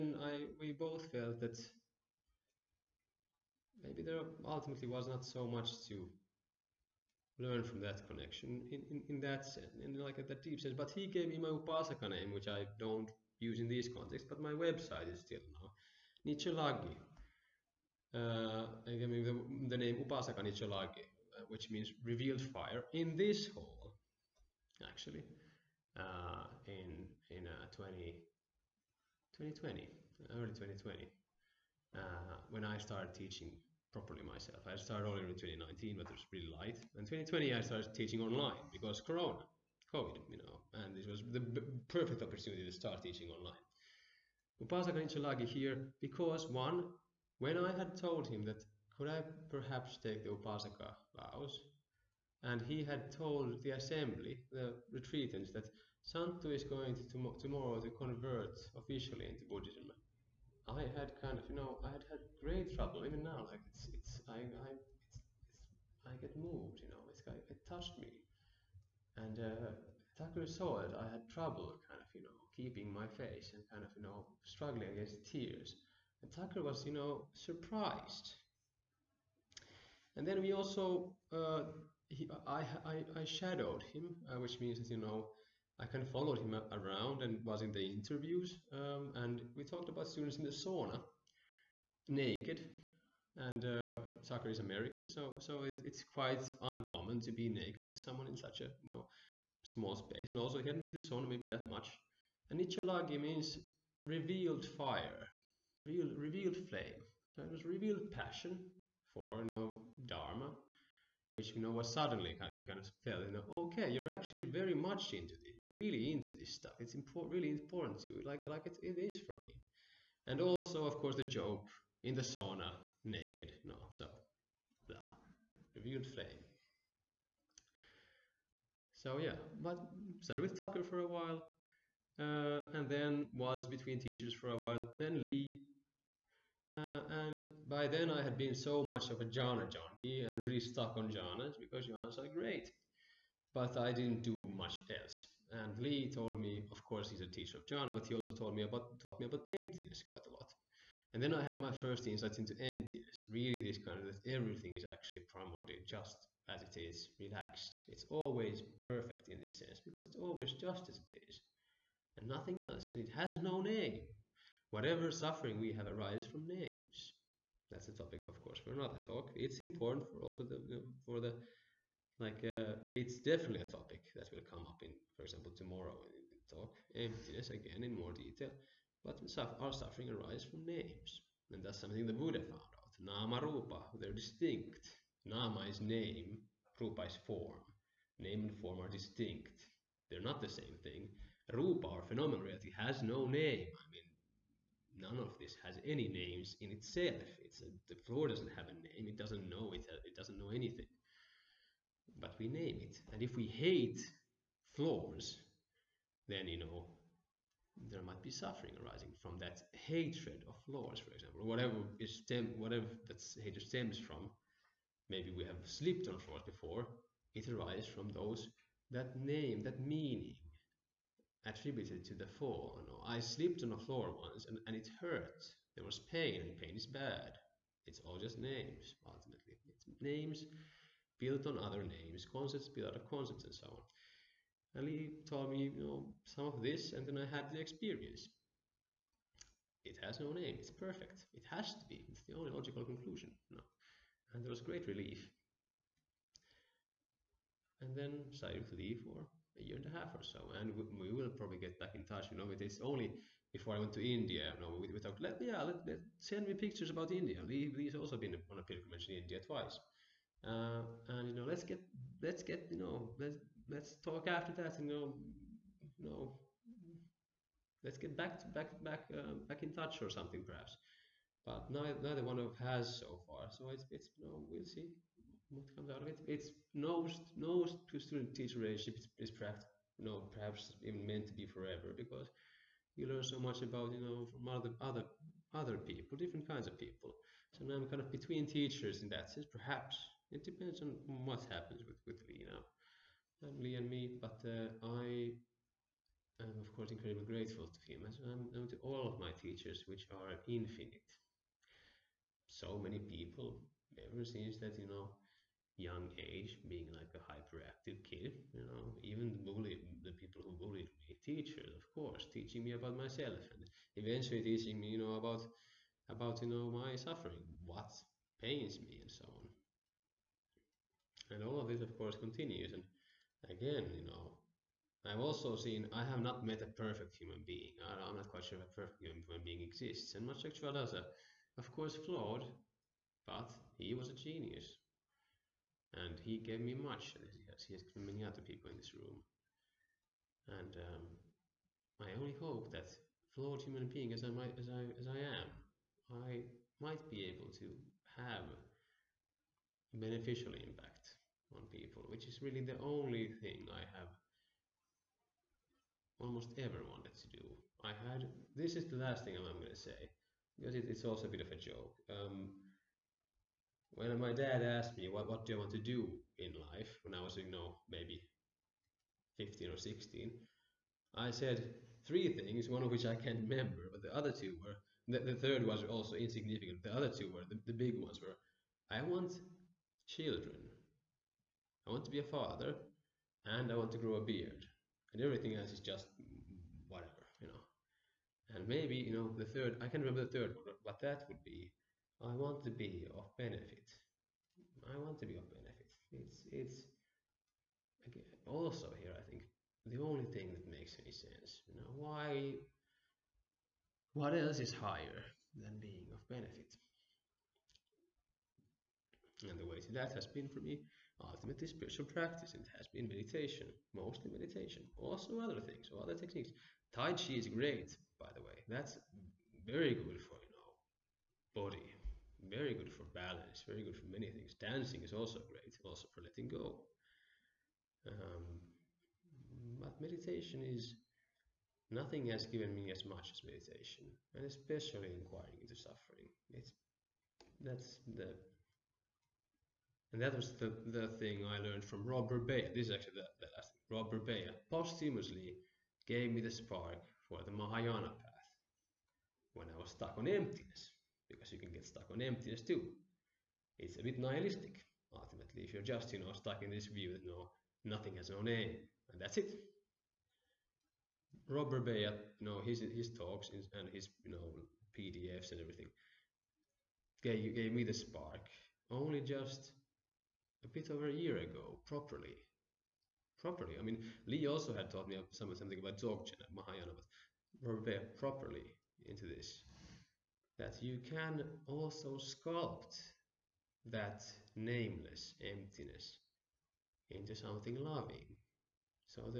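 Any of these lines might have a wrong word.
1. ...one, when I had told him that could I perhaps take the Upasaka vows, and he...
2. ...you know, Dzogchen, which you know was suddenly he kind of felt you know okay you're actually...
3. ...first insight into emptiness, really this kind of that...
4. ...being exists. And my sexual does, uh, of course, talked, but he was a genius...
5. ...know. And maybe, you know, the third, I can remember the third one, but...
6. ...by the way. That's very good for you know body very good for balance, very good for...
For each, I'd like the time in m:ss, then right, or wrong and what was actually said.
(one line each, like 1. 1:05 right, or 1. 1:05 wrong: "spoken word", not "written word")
1. 0:46 right
2. 1:49 wrong: "Dharma", not "Dzogchen"
3. 2:31 right
4. 5:29 wrong: "flawed", not "talked"
5. 6:27 right
6. 6:58 right.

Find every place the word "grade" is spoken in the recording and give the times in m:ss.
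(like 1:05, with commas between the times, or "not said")
not said.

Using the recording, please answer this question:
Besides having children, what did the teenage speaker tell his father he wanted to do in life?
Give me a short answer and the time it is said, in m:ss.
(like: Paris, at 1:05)
grow a beard, at 6:23.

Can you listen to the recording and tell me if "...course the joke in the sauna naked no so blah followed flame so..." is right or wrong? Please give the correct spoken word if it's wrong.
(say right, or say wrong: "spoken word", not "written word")
wrong: "revealed", not "followed".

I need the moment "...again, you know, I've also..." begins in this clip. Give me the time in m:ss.
5:23.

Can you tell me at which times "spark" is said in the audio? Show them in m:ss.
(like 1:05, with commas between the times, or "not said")
7:26, 7:47.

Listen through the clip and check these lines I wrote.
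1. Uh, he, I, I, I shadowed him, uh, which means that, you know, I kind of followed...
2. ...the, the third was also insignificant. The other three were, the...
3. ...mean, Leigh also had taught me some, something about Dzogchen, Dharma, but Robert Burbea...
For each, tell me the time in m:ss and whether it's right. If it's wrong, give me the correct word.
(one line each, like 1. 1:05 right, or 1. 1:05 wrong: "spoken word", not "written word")
1. 1:21 right
2. 6:15 wrong: "two", not "three"
3. 7:53 wrong: "Mahayana", not "Dharma".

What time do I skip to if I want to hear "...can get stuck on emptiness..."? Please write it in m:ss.
7:31.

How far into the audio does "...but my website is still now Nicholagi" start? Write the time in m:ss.
0:14.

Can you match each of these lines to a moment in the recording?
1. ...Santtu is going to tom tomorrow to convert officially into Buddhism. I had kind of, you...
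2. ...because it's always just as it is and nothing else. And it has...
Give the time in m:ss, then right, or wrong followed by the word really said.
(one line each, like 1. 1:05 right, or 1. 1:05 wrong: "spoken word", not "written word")
1. 0:56 right
2. 2:39 right.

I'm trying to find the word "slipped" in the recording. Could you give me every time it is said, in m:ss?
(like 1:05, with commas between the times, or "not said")
3:43.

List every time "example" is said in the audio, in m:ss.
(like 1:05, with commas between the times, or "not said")
2:55, 3:31.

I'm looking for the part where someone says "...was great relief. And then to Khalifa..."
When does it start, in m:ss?
4:04.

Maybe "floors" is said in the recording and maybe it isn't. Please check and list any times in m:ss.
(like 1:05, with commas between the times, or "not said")
3:18, 3:24, 3:30, 3:36, 3:43.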